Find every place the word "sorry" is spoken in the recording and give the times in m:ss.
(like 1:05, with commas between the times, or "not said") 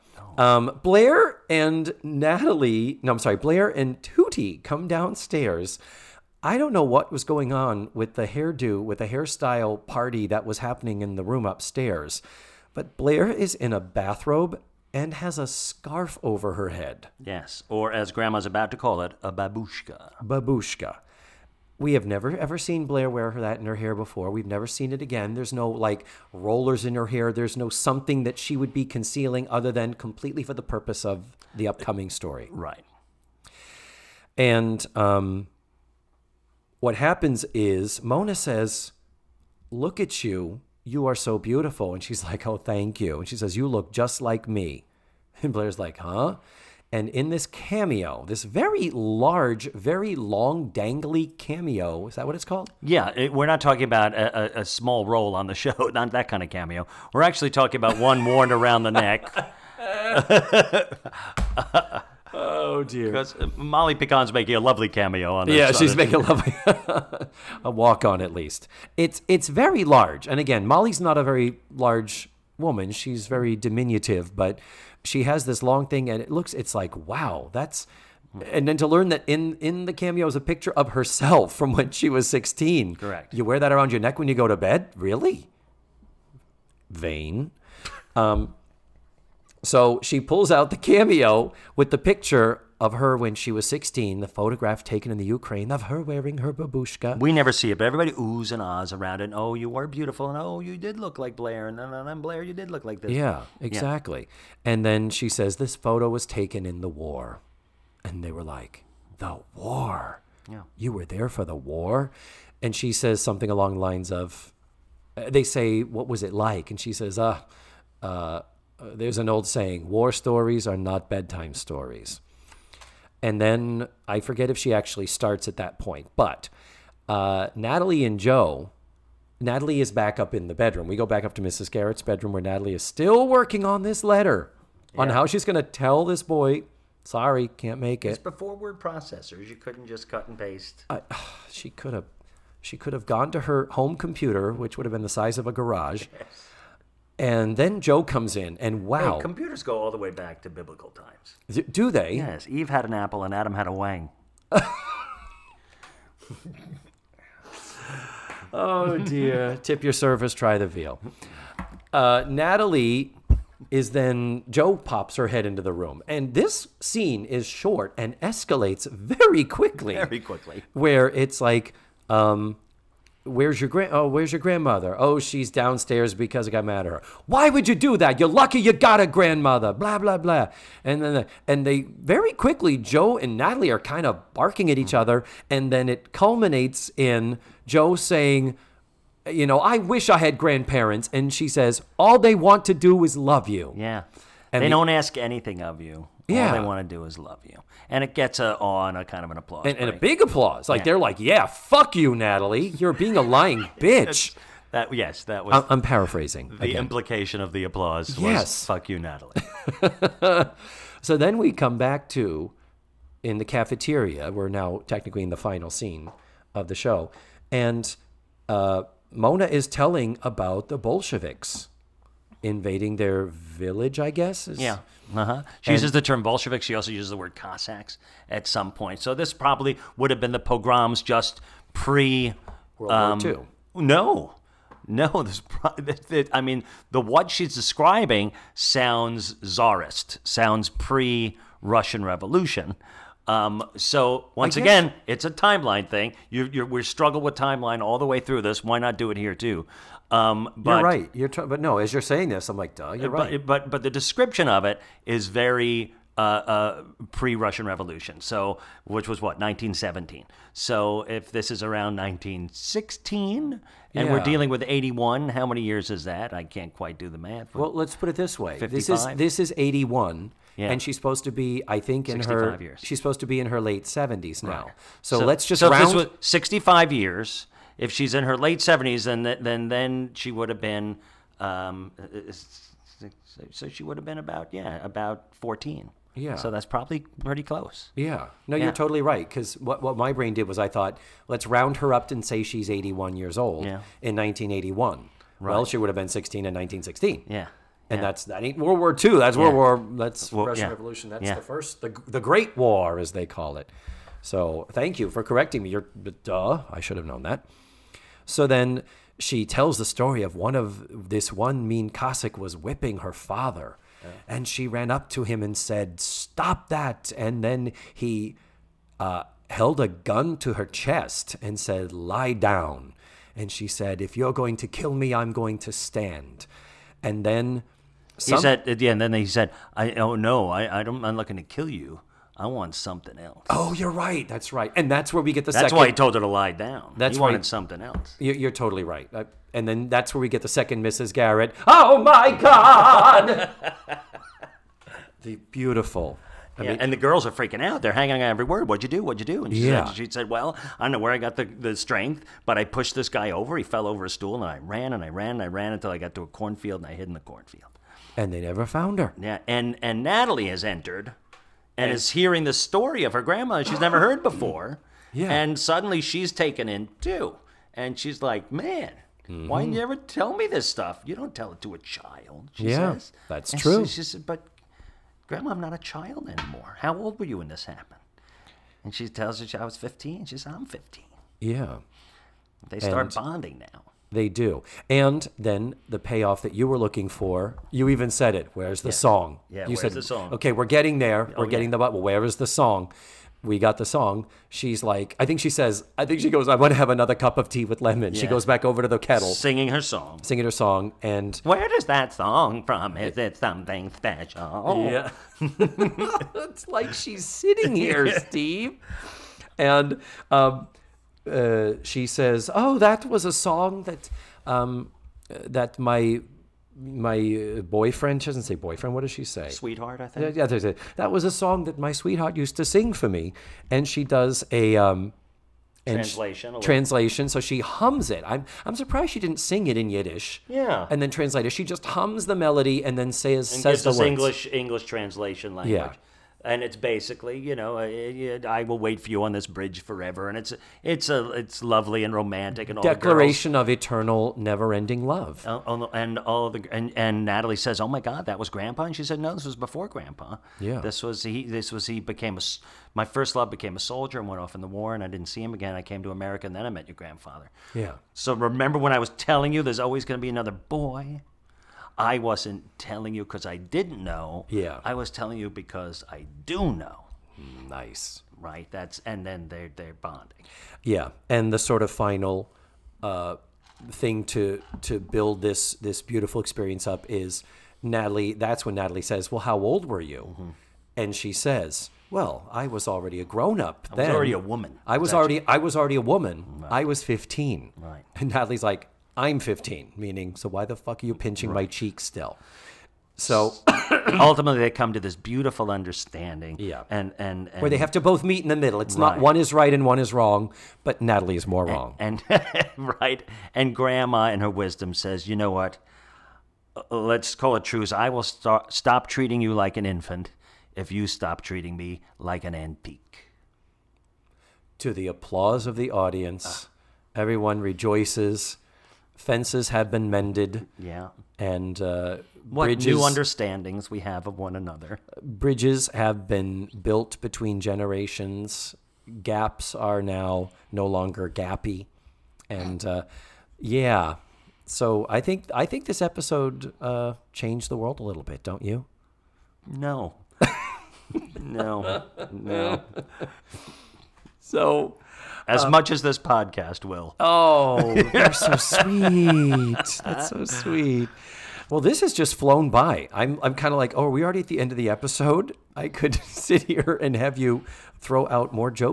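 0:03, 2:17.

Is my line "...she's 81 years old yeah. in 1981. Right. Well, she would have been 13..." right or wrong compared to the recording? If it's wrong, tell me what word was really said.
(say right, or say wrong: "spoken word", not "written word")
wrong: "16", not "13".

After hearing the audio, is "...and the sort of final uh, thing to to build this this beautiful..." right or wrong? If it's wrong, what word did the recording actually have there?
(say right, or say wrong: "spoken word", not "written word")
right.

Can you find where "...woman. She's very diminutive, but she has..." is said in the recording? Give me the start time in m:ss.
1:12.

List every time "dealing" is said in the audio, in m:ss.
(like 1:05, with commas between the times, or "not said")
4:24.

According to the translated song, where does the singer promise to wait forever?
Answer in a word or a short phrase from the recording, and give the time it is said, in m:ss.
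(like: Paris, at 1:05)
on this bridge, at 7:19.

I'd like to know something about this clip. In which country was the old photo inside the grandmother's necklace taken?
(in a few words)
Ukraine.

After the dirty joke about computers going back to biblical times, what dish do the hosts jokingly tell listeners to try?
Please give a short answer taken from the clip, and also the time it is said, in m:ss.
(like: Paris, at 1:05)
the veal, at 2:40.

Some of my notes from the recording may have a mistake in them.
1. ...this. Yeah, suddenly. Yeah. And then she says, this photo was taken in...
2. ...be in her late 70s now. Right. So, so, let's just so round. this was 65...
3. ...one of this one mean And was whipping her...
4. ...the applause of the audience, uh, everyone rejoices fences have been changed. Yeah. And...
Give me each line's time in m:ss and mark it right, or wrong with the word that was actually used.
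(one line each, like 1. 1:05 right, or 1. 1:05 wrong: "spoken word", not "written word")
1. 1:42 wrong: "exactly", not "suddenly"
2. 4:33 right
3. 5:10 wrong: "Cossack", not "And"
4. 8:34 wrong: "mended", not "changed".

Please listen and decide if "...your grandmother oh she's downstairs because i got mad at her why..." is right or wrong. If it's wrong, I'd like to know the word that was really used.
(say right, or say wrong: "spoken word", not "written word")
right.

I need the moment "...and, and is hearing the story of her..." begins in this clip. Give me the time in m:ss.
6:01.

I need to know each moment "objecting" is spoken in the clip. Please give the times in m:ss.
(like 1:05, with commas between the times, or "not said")
not said.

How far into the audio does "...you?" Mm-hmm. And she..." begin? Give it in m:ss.
8:00.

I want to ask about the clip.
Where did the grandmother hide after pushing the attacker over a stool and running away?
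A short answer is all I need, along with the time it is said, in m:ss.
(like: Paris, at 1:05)
a cornfield, at 5:56.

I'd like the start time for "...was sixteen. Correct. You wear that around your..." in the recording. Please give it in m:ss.
1:22.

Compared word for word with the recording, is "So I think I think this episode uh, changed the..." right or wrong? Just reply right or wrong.
right.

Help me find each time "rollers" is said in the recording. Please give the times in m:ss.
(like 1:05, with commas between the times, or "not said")
0:26.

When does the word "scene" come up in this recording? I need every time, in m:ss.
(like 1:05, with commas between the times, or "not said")
2:46, 3:35.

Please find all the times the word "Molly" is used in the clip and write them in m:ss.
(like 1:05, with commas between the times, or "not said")
1:03, 1:10.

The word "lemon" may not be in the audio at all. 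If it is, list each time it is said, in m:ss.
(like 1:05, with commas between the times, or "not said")
6:37.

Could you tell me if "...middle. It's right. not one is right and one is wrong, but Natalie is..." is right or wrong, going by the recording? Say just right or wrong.
right.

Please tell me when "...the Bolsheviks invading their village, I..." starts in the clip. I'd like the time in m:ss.
3:40.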